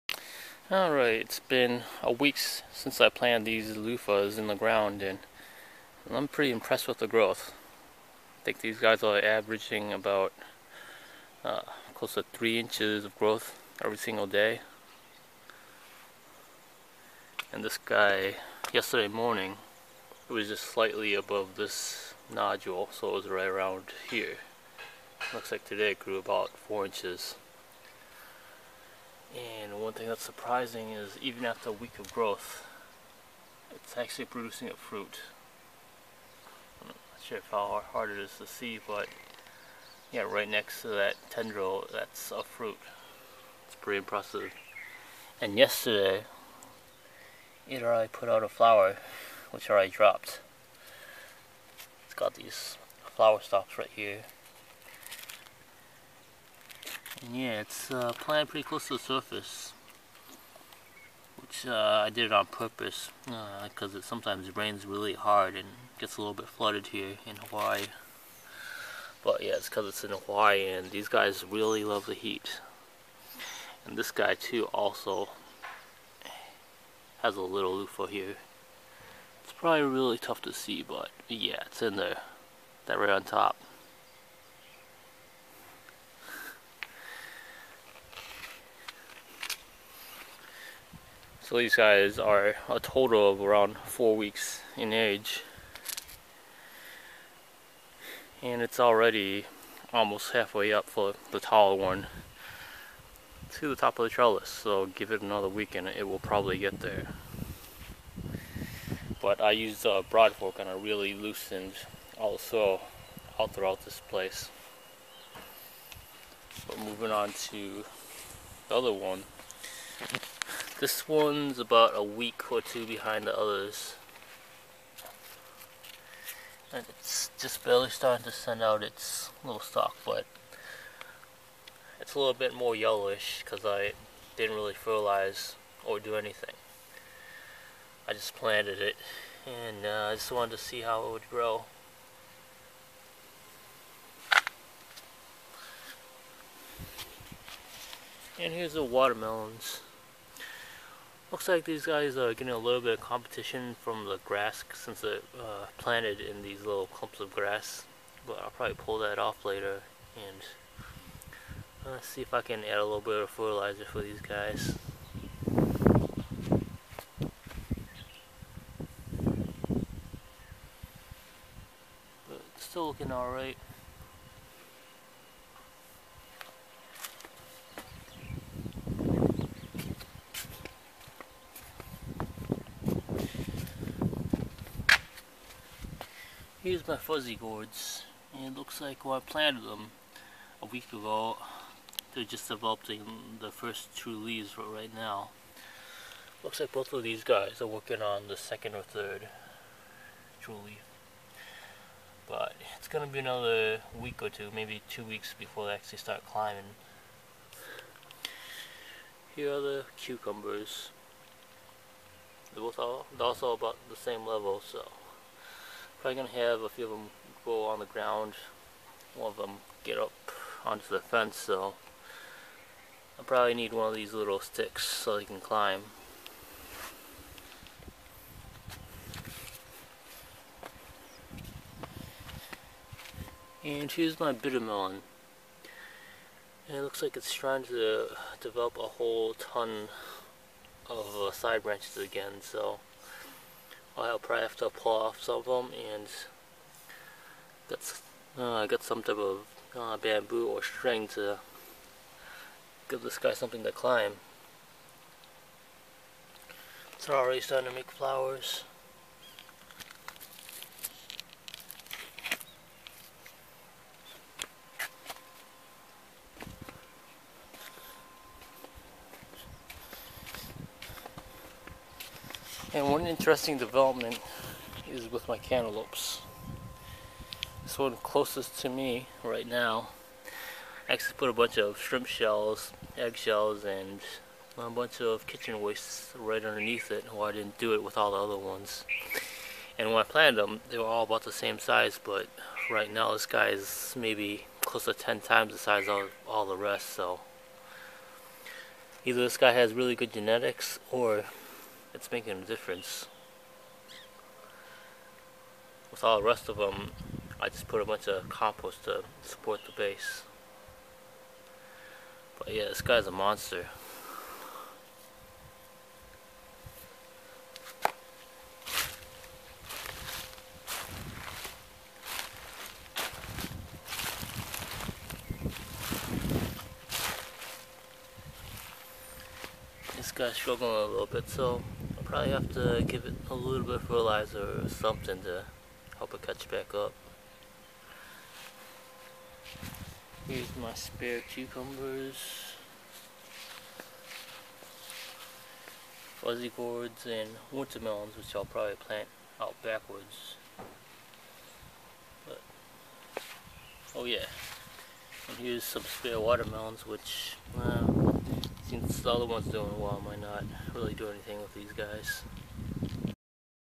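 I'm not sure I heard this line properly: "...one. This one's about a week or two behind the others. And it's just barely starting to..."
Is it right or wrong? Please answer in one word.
right.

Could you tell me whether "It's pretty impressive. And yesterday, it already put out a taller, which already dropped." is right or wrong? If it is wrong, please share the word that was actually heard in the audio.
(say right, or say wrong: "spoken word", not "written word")
wrong: "flower", not "taller".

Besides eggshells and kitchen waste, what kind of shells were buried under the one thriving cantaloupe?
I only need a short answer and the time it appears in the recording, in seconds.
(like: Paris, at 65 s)
shrimp shells, at 281 s.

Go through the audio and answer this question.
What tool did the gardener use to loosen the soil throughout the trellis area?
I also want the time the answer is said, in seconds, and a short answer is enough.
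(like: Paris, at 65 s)
broad fork, at 110 s.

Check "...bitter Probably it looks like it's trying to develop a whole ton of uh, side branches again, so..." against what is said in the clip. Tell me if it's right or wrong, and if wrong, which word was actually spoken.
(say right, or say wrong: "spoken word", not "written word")
wrong: "And", not "Probably".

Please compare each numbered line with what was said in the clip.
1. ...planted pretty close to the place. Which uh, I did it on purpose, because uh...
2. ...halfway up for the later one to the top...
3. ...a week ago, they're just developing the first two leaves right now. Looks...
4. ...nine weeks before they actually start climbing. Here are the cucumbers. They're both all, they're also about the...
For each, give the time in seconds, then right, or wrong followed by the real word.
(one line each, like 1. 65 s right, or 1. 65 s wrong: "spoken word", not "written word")
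1. 58 s wrong: "surface", not "place"
2. 100 s wrong: "taller", not "later"
3. 190 s right
4. 204 s wrong: "two", not "nine".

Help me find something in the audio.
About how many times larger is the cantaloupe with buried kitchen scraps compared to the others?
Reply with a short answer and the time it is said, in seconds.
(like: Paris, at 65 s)
10 times, at 294 s.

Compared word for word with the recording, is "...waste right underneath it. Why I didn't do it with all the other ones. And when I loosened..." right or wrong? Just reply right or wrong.
wrong.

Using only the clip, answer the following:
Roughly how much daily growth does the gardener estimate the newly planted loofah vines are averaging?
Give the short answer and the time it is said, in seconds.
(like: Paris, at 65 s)
3 inches, at 12 s.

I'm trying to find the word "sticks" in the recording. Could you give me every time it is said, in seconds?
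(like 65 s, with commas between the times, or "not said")
224 s.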